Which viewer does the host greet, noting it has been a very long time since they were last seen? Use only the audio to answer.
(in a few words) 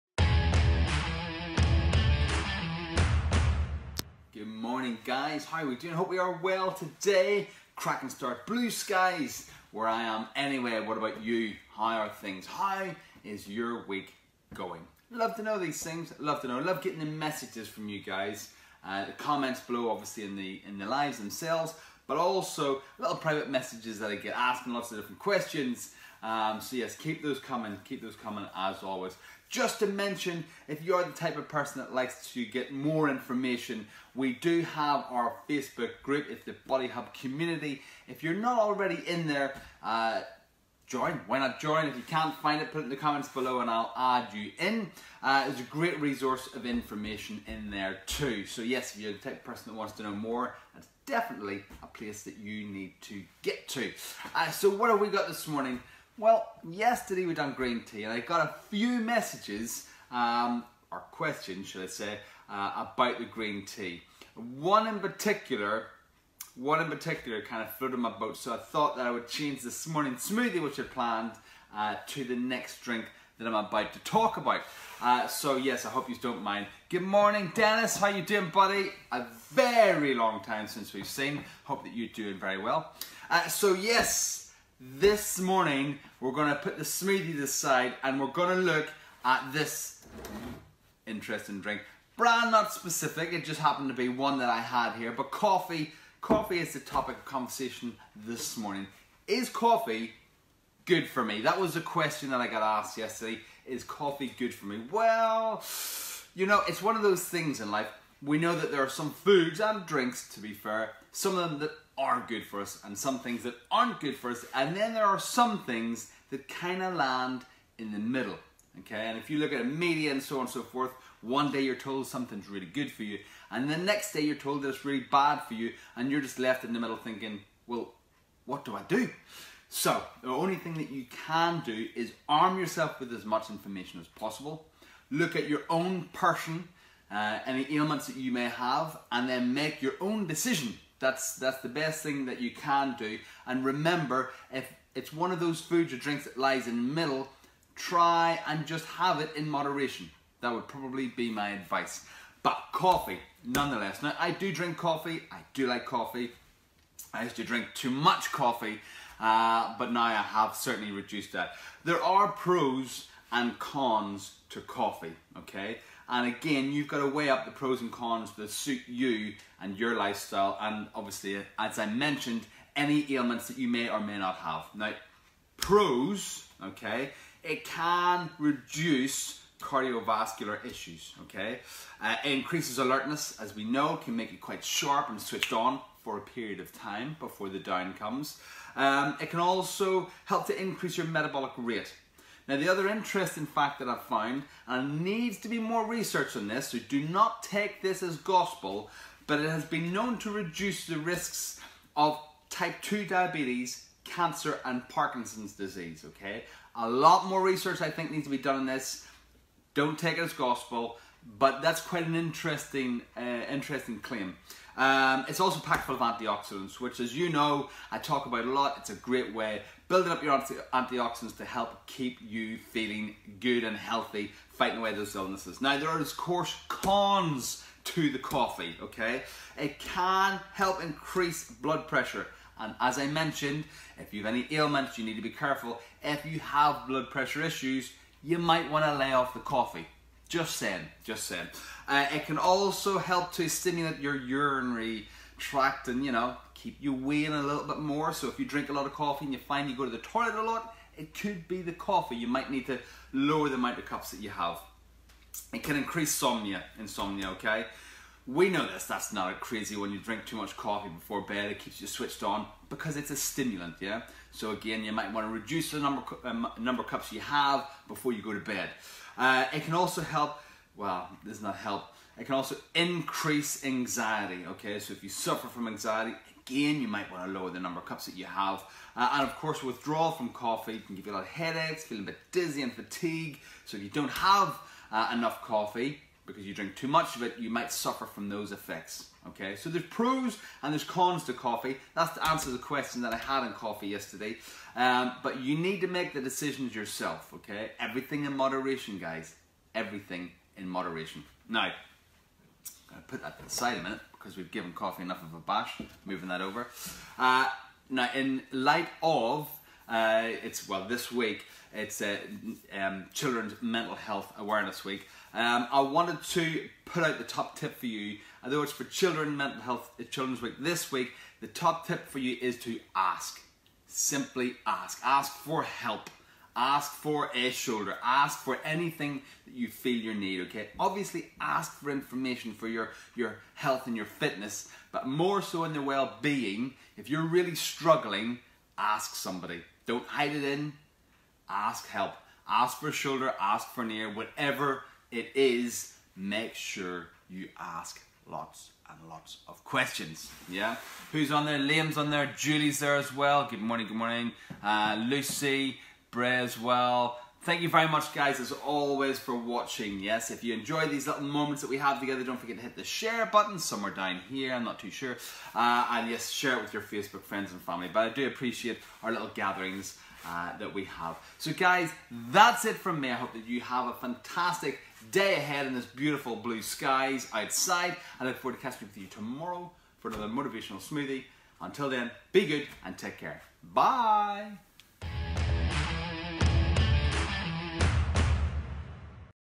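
Dennis.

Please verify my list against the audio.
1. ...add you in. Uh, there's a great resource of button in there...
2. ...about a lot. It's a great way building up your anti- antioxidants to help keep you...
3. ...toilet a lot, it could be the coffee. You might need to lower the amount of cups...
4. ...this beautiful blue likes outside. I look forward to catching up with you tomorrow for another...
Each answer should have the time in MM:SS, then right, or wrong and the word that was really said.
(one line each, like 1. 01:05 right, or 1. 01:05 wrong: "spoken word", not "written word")
1. 00:43 wrong: "information", not "button"
2. 03:38 right
3. 04:09 right
4. 06:15 wrong: "skies", not "likes".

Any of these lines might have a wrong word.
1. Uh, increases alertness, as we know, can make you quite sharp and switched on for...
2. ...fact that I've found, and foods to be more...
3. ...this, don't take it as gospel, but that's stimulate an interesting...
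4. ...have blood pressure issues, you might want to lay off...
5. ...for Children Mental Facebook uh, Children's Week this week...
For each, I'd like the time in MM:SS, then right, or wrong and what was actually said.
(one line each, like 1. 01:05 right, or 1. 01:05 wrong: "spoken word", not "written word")
1. 03:02 right
2. 03:13 wrong: "needs", not "foods"
3. 03:28 wrong: "quite", not "stimulate"
4. 03:56 right
5. 05:18 wrong: "Health", not "Facebook".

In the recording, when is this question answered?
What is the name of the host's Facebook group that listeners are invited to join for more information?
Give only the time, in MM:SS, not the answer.
00:36.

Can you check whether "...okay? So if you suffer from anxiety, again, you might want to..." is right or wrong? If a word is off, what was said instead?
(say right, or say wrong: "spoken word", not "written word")
right.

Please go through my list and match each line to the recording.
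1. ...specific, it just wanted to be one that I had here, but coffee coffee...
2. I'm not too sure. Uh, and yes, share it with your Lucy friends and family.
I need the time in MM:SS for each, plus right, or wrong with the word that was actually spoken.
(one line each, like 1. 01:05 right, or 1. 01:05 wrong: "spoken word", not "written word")
1. 01:32 wrong: "happened", not "wanted"
2. 06:04 wrong: "Facebook", not "Lucy".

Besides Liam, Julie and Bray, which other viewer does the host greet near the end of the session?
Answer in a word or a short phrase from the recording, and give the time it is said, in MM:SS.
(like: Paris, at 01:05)
Lucy, at 05:55.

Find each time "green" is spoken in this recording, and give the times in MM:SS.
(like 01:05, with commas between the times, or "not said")
00:57, 01:03.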